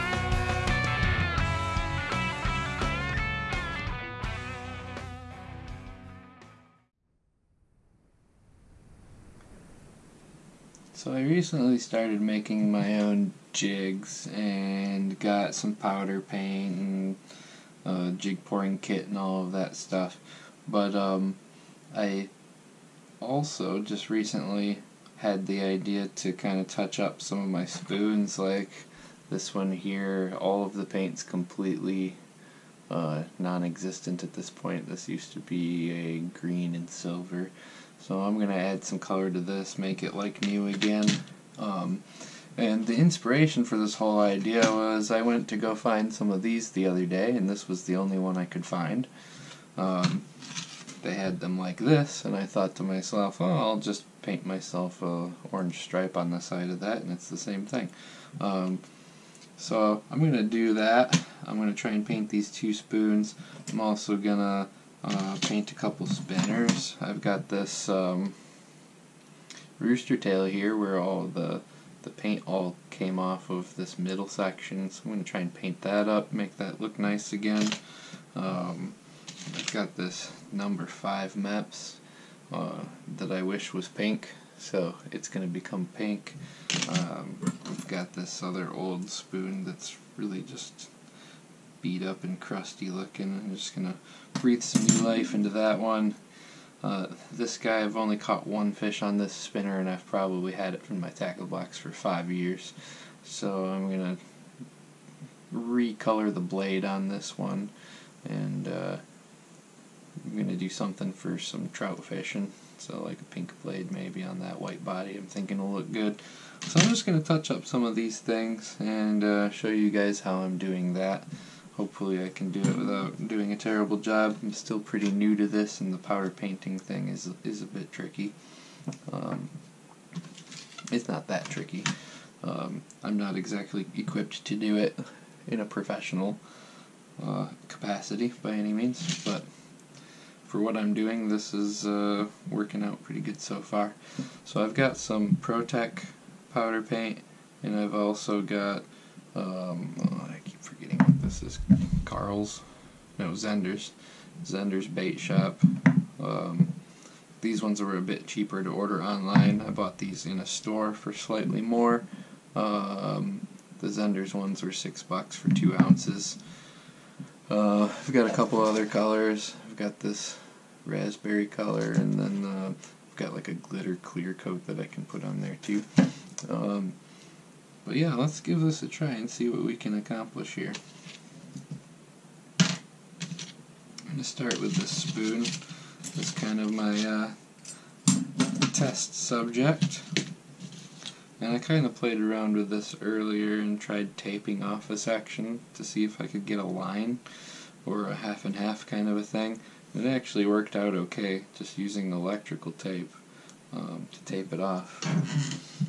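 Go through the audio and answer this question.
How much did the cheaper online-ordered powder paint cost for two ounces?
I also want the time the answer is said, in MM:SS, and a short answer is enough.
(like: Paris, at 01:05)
$6, at 02:44.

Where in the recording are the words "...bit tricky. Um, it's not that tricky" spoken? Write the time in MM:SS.
02:07.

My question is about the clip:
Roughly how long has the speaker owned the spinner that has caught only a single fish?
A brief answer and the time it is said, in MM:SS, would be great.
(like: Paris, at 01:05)
5 years, at 01:41.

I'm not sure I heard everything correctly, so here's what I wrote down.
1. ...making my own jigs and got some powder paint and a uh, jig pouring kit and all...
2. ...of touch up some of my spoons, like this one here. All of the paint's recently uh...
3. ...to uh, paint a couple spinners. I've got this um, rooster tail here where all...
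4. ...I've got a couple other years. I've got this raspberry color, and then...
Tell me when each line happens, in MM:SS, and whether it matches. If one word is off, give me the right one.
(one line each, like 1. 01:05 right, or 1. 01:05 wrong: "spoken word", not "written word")
1. 00:12 right
2. 00:26 wrong: "completely", not "recently"
3. 01:04 right
4. 02:47 wrong: "colors", not "years".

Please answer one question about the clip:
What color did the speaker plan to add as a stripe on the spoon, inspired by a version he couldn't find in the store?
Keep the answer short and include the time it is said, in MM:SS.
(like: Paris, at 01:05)
orange, at 00:55.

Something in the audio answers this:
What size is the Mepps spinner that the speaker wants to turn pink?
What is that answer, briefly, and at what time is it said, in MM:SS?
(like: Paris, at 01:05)
5, at 01:20.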